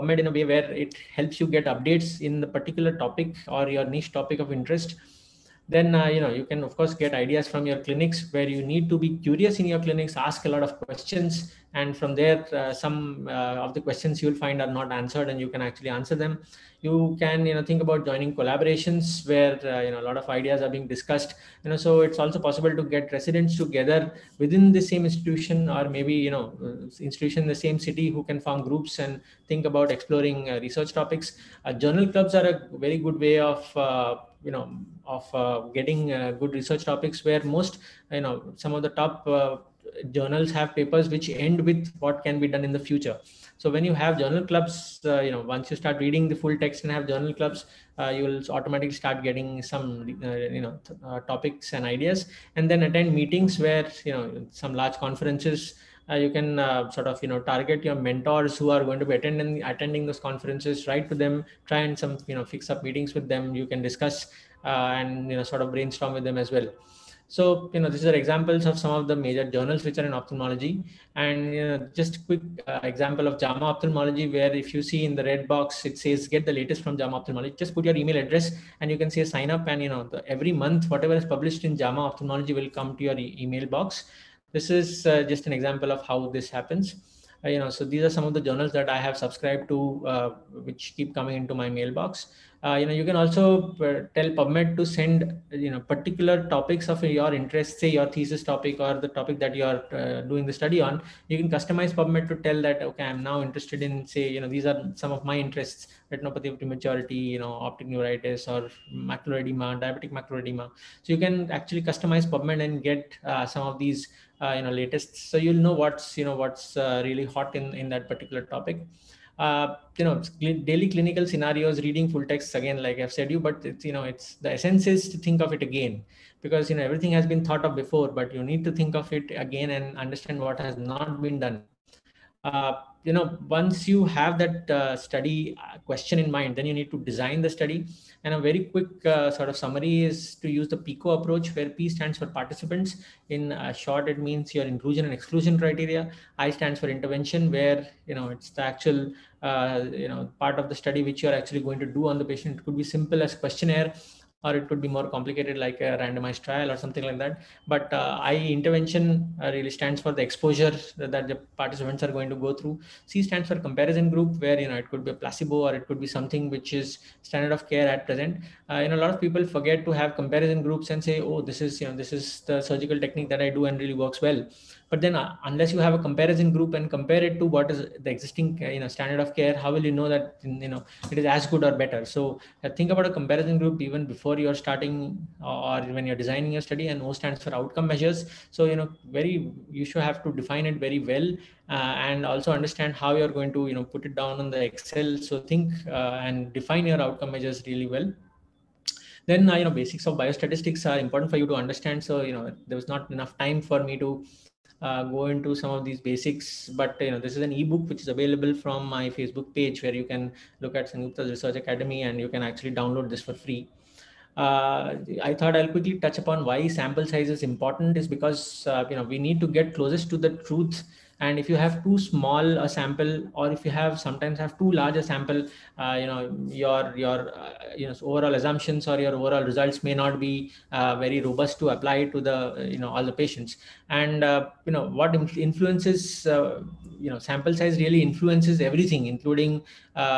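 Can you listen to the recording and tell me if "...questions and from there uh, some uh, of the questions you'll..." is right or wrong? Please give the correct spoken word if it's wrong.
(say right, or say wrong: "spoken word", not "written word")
right.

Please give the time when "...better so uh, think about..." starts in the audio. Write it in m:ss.
3:01.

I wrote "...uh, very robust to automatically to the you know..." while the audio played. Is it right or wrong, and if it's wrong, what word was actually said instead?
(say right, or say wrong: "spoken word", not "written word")
wrong: "apply", not "automatically".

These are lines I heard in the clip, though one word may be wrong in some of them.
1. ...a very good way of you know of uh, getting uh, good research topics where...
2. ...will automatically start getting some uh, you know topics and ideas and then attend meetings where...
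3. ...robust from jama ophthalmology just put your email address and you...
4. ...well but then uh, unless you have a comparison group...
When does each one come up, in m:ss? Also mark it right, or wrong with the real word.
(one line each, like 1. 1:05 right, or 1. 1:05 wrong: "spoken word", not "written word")
1. 0:32 right
2. 0:48 right
3. 1:16 wrong: "latest", not "robust"
4. 2:54 right.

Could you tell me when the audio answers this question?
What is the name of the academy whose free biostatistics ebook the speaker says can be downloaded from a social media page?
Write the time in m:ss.
3:30.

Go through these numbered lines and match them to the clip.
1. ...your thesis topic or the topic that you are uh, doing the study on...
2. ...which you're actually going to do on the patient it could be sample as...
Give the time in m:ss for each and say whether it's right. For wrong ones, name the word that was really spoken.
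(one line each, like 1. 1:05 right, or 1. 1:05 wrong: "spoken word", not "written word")
1. 1:37 right
2. 2:31 wrong: "simple", not "sample".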